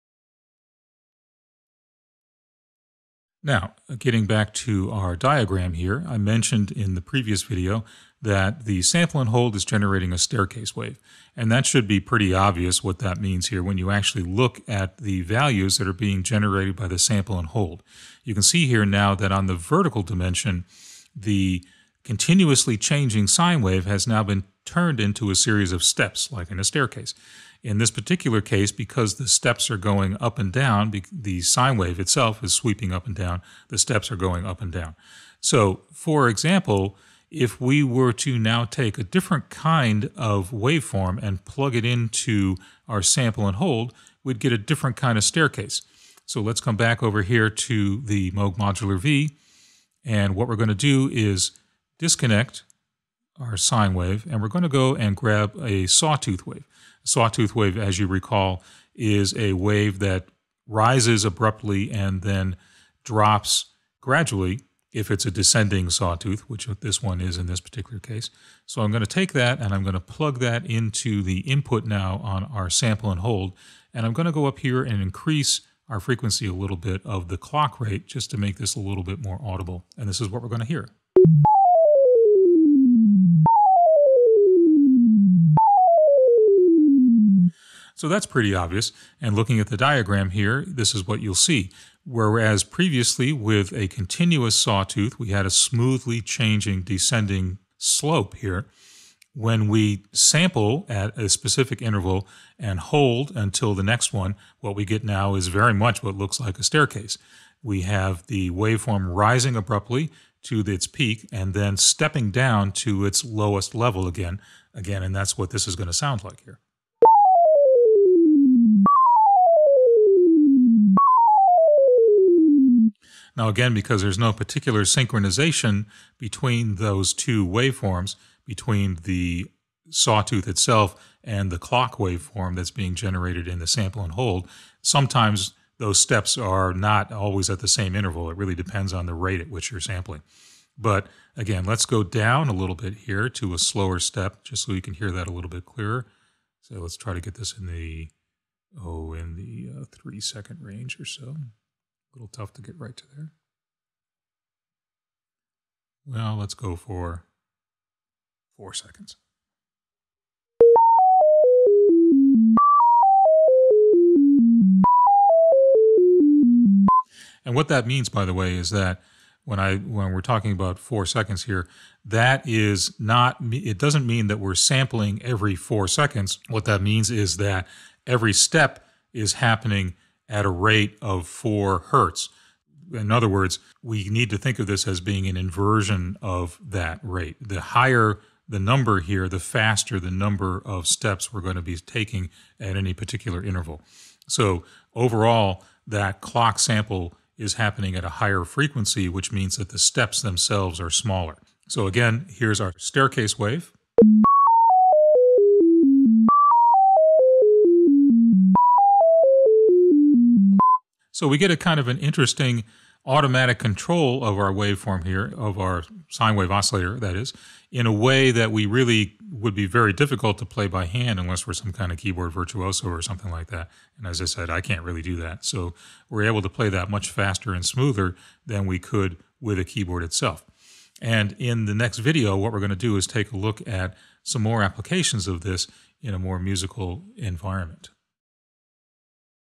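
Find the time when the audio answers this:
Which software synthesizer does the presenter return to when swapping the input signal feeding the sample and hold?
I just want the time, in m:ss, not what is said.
0:48.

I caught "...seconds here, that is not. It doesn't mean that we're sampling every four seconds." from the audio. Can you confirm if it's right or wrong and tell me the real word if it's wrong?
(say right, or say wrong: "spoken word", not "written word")
right.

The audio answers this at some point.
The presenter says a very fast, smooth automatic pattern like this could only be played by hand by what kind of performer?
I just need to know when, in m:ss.
3:41.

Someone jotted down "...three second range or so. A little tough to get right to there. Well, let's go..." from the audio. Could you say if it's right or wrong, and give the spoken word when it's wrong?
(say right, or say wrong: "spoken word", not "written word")
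right.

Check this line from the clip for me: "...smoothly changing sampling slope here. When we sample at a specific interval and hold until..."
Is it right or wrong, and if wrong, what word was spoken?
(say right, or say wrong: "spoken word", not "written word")
wrong: "descending", not "sampling".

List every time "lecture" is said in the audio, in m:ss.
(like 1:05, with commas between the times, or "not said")
not said.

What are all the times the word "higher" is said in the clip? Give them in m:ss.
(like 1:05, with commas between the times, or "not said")
3:07, 3:18.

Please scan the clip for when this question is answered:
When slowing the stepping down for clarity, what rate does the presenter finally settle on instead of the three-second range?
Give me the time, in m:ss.
3:01.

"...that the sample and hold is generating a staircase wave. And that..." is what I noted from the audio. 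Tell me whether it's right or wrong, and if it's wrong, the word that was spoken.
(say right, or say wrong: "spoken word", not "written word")
right.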